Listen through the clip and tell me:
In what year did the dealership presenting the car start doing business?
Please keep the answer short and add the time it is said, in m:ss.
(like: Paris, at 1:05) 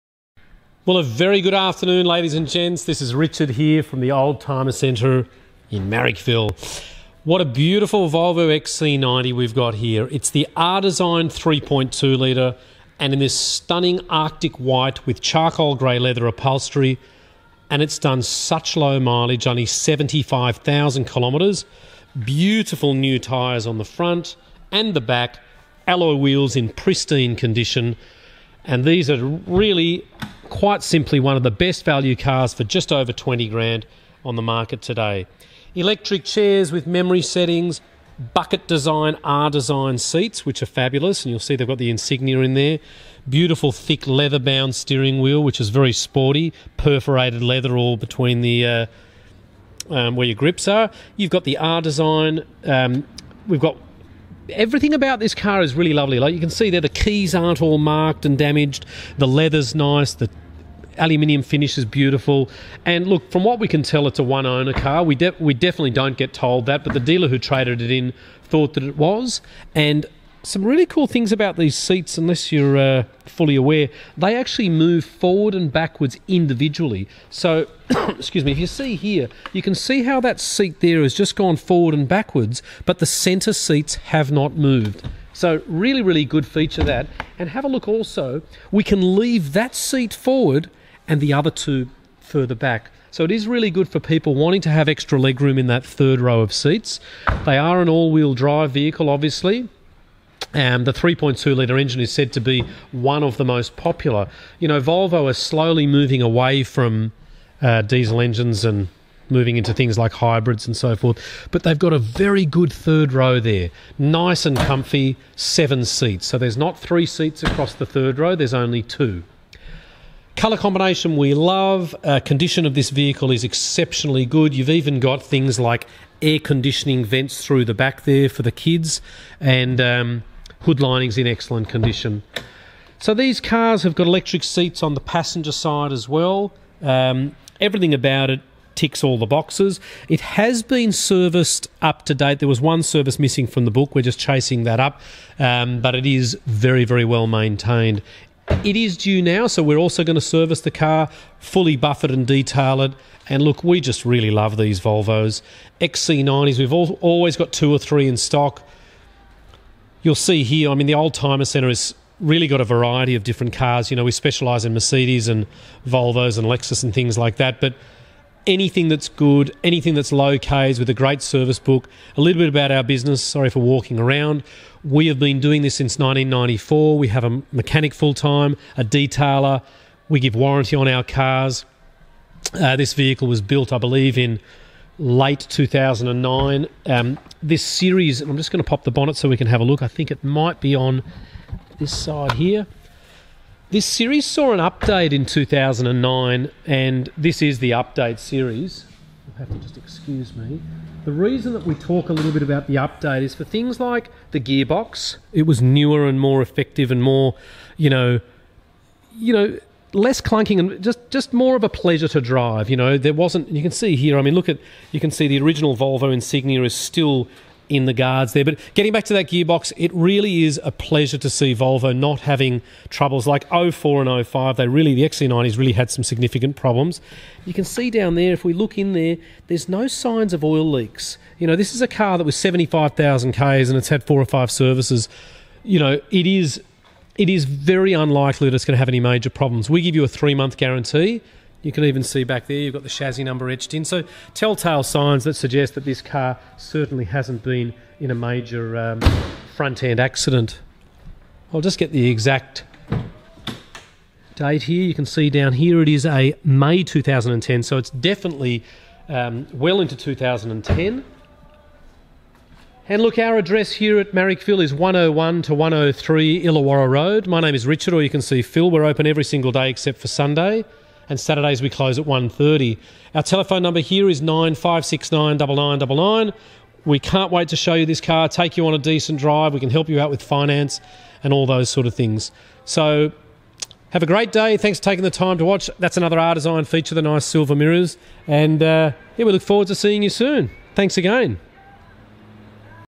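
1994, at 2:55.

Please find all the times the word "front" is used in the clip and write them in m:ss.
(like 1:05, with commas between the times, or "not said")
0:23, 4:09.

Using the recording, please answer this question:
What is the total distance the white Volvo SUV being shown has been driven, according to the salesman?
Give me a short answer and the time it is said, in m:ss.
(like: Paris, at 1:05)
75,000 kilometres, at 0:19.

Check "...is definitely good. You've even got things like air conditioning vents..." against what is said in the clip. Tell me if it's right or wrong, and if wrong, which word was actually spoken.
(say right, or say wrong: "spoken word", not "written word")
wrong: "exceptionally", not "definitely".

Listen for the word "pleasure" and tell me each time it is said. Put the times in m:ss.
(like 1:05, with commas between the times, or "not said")
3:31, 3:40.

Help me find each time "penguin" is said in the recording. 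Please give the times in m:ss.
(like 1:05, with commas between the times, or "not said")
not said.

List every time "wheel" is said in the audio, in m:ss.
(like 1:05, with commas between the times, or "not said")
0:26, 0:45, 1:38.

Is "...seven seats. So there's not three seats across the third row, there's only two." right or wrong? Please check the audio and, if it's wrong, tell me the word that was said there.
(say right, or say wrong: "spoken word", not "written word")
right.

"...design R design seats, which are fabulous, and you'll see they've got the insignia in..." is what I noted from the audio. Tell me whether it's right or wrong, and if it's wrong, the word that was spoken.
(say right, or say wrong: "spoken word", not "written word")
right.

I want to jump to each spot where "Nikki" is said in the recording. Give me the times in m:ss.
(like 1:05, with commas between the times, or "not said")
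not said.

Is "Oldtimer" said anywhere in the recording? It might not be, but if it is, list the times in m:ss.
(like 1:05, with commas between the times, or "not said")
0:04, 2:40.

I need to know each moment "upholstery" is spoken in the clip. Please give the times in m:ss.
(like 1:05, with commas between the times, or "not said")
0:16.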